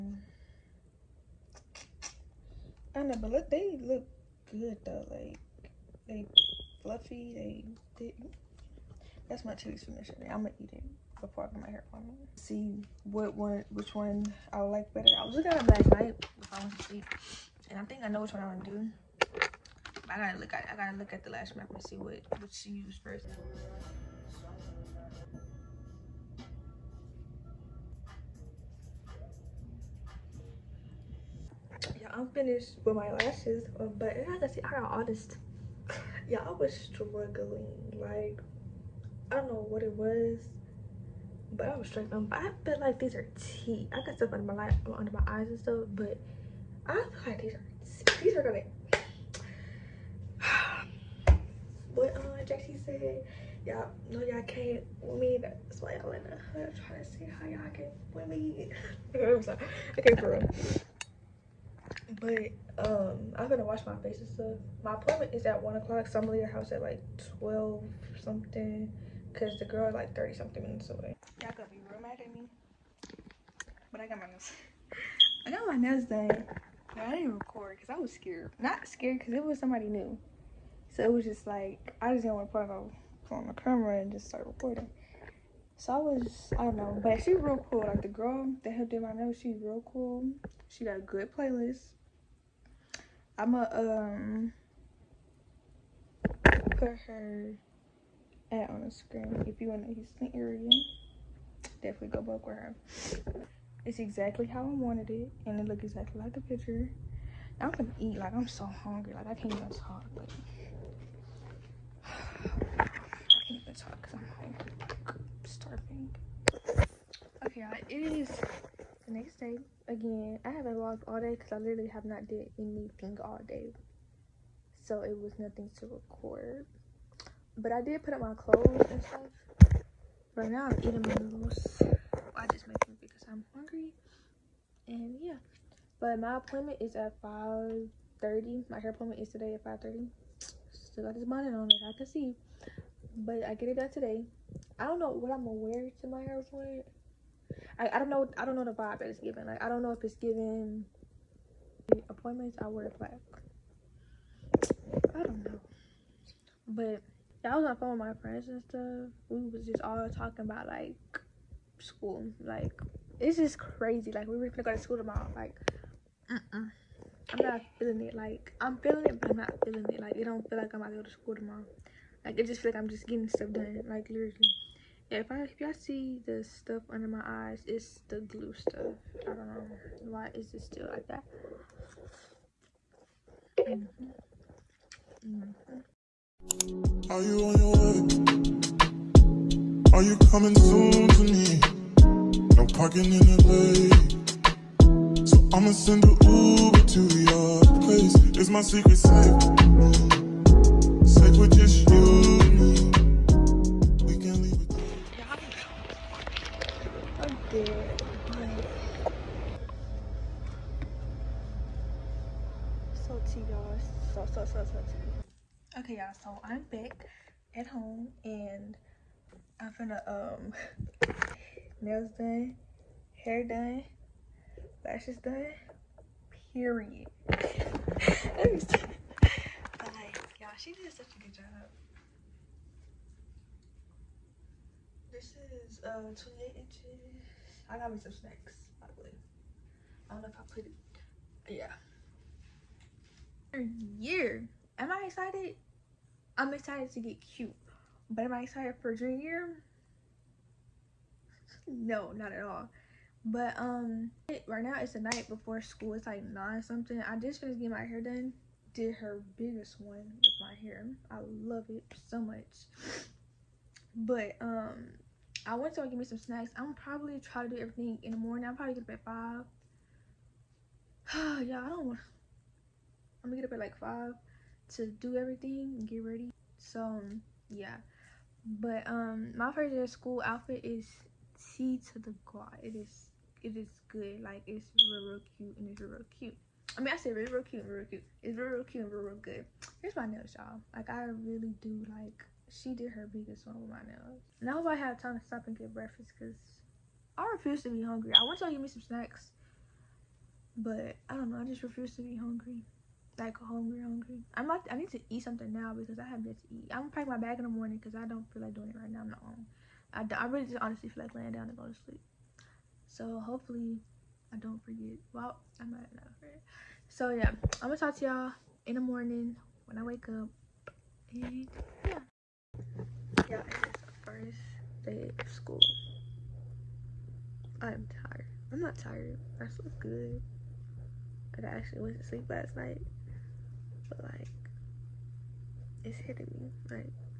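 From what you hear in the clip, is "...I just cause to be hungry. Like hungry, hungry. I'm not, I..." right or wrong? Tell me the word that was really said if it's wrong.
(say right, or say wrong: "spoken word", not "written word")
wrong: "refuse", not "cause".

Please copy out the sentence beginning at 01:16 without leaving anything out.
No, I didn't record cause I was scared.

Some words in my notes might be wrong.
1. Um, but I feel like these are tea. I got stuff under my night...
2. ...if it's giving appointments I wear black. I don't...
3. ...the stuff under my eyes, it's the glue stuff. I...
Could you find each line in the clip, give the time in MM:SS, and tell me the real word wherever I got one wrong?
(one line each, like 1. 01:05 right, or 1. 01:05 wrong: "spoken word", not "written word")
1. 00:42 wrong: "light", not "night"
2. 02:29 right
3. 02:56 right.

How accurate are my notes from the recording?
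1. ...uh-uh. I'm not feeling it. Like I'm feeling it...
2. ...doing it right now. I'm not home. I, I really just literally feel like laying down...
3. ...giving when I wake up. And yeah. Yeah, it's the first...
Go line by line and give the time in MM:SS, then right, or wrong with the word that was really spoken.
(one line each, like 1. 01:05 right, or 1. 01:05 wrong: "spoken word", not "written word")
1. 02:46 right
2. 05:08 wrong: "honestly", not "literally"
3. 05:18 wrong: "morning", not "giving".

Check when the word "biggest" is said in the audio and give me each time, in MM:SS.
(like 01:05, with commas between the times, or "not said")
04:19, 04:53.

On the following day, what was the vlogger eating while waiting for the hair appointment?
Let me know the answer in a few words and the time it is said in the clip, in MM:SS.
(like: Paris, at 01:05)
noodles, at 02:11.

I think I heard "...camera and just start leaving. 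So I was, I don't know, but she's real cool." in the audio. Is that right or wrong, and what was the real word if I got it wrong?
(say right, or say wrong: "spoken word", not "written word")
wrong: "recording", not "leaving".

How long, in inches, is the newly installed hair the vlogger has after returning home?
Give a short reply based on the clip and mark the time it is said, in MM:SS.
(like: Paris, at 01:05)
28 inches, at 03:56.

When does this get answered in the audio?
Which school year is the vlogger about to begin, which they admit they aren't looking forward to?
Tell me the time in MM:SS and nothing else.
04:08.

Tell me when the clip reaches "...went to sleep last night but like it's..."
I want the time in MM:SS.
05:31.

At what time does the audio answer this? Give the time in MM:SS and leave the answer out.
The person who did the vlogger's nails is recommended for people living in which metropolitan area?
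01:39.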